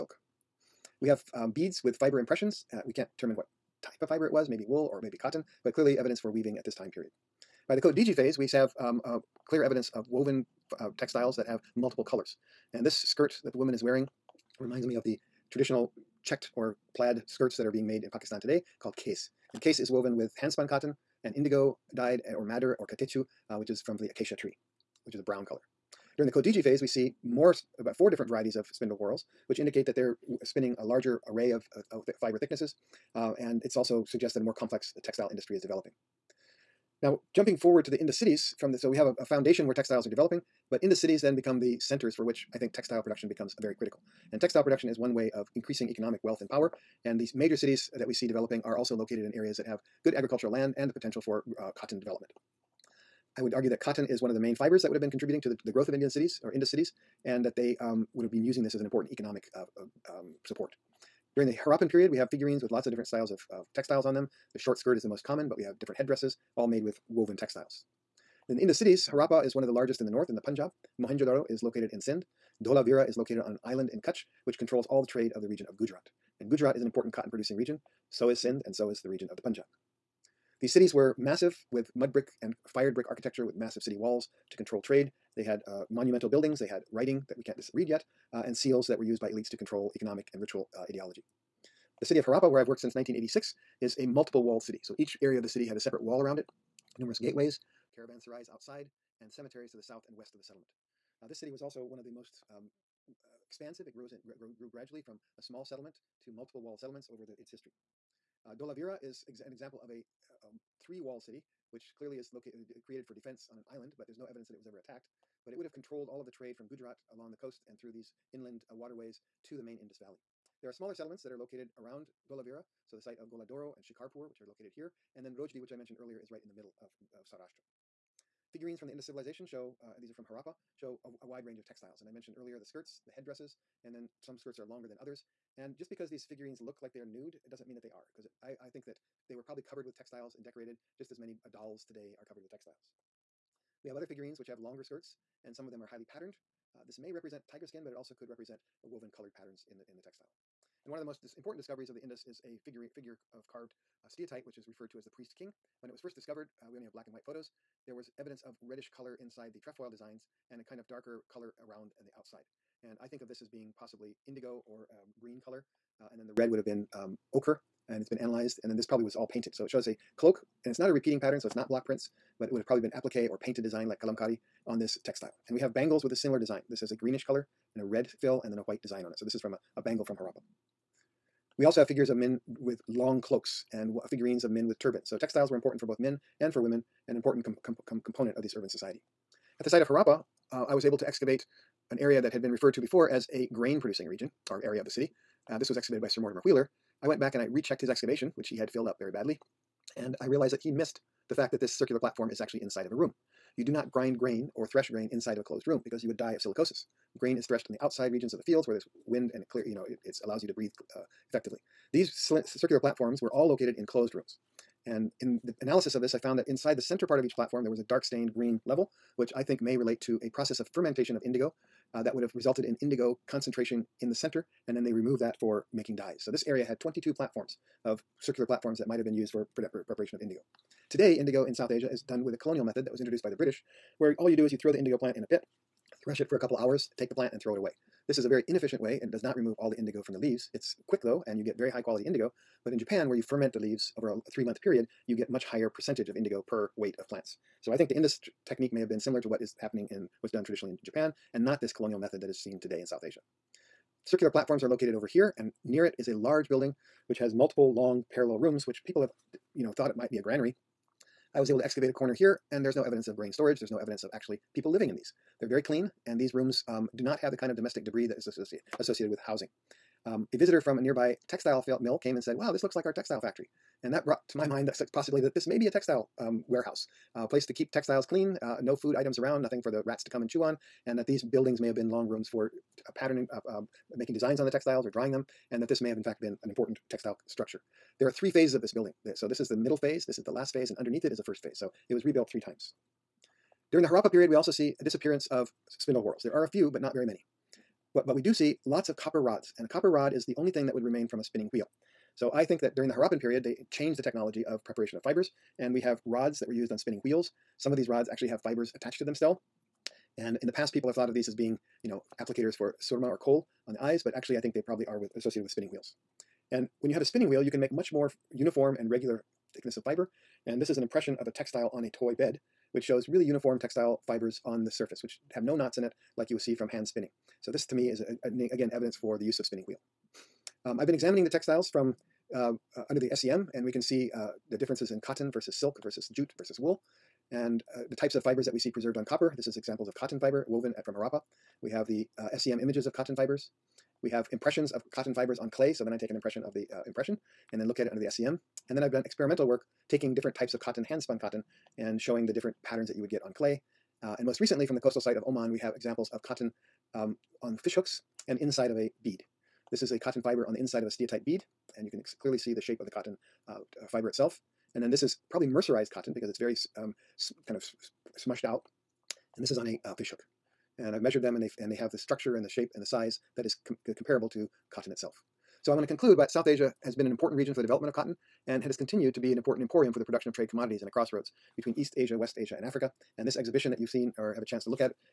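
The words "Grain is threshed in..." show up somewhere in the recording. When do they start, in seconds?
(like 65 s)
207 s.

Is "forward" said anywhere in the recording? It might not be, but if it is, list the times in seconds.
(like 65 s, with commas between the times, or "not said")
37 s.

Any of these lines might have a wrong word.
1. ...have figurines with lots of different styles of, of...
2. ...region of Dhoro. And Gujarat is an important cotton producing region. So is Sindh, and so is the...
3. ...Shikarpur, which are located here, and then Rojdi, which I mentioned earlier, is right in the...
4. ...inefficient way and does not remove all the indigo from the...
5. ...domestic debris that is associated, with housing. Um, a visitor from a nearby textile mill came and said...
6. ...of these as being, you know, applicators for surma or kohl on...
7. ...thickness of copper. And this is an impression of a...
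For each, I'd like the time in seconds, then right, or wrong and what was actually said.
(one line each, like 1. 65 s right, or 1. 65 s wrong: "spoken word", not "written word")
1. 62 s right
2. 75 s wrong: "Gujarat", not "Dhoro"
3. 123 s right
4. 238 s right
5. 267 s right
6. 311 s right
7. 319 s wrong: "fiber", not "copper".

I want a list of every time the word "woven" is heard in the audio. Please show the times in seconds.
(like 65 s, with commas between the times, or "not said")
10 s, 19 s, 67 s, 148 s, 340 s.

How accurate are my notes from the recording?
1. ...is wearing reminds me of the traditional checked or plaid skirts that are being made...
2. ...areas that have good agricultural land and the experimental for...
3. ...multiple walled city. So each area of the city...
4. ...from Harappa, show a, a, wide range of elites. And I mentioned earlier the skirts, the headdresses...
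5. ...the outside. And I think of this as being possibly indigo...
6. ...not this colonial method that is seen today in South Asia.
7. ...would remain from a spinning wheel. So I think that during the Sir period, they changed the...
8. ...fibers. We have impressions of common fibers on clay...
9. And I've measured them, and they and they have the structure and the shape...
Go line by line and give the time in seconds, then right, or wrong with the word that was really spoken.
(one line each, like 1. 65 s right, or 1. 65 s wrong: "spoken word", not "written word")
1. 13 s right
2. 49 s wrong: "potential", not "experimental"
3. 94 s right
4. 130 s wrong: "textiles", not "elites"
5. 162 s right
6. 251 s right
7. 300 s wrong: "Harappan", not "Sir"
8. 343 s wrong: "cotton", not "common"
9. 370 s right.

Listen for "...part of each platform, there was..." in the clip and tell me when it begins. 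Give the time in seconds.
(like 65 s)
217 s.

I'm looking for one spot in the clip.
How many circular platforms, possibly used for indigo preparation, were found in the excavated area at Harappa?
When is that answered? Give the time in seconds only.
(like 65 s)
226 s.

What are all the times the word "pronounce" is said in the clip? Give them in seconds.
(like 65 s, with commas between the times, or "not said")
not said.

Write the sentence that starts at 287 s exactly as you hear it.
There are three phases of this building.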